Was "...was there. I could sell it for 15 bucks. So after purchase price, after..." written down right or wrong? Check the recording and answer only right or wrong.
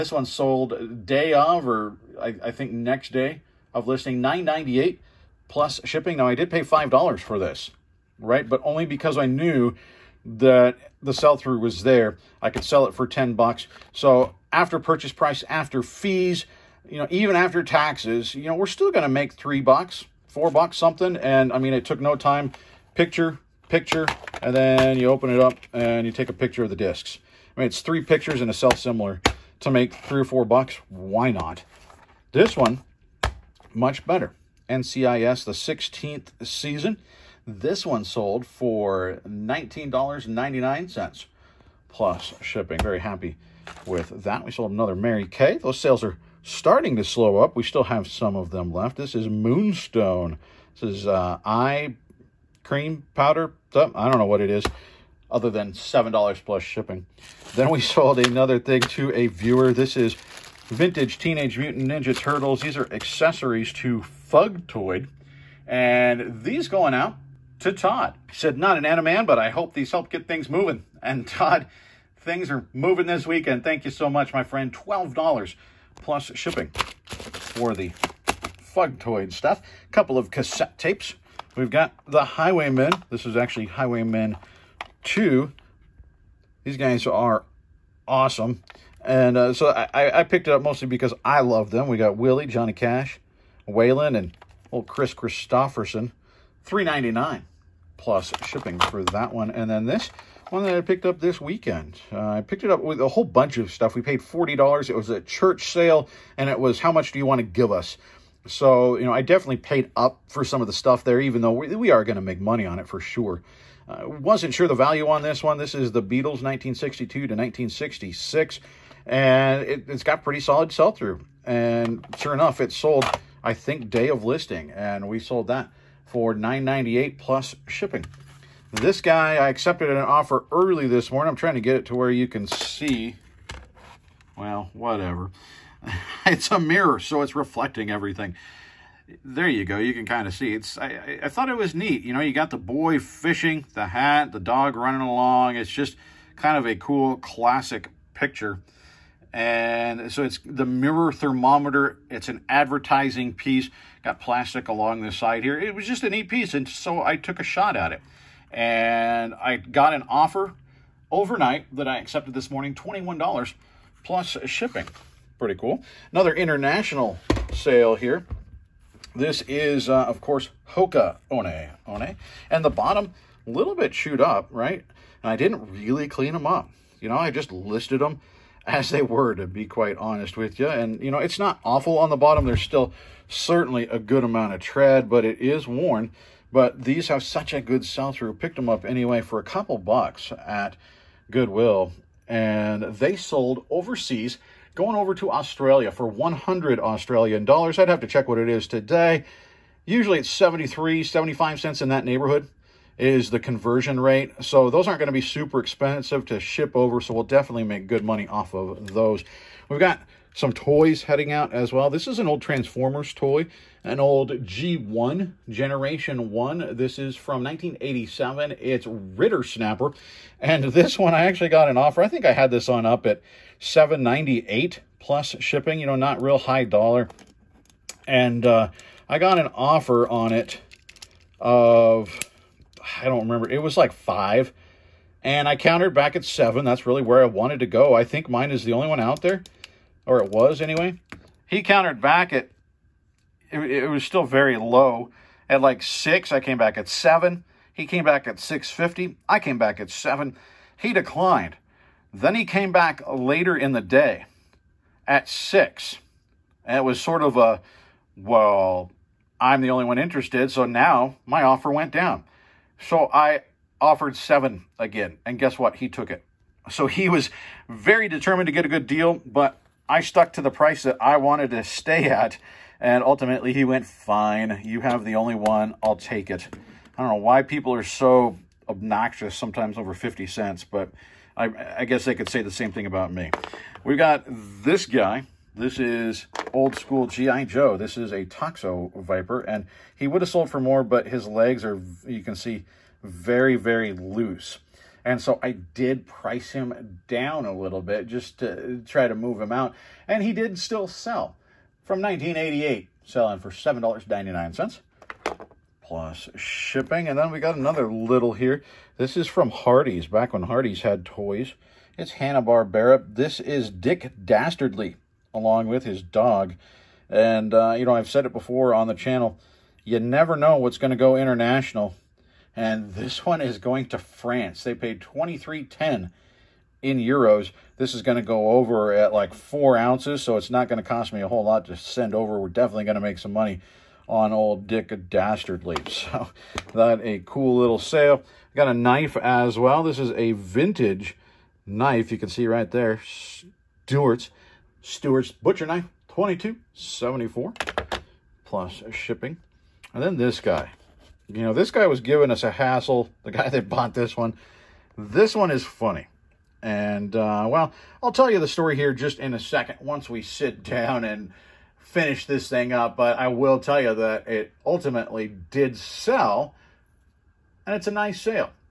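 wrong.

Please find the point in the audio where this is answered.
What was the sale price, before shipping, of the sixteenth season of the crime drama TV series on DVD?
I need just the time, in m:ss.
0:39.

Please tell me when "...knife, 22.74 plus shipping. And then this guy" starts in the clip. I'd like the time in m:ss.
5:45.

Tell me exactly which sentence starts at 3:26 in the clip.
So we'll definitely make good money off of those.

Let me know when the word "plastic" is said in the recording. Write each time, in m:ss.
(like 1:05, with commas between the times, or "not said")
2:34.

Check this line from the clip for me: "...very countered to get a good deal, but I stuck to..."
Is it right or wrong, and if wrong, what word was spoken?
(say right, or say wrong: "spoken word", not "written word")
wrong: "determined", not "countered".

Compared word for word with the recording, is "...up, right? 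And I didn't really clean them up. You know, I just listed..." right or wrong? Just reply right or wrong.
right.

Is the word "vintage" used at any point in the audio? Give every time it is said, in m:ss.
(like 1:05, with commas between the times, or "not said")
1:00, 5:40.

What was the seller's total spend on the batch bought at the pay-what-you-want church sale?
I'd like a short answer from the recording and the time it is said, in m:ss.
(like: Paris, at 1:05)
$40, at 1:44.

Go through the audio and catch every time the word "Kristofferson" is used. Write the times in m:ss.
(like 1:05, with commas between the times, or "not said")
1:35.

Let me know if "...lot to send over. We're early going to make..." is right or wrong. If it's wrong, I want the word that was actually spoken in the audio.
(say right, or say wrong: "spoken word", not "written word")
wrong: "definitely", not "early".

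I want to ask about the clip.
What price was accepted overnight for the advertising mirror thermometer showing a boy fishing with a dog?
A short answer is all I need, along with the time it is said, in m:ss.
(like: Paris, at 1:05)
$21, at 2:42.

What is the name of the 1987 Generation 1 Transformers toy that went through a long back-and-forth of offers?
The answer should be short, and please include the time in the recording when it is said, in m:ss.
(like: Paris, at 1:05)
Rippersnapper, at 3:38.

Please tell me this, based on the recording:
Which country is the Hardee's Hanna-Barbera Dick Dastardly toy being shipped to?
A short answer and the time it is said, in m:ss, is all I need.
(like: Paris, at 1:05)
France, at 5:23.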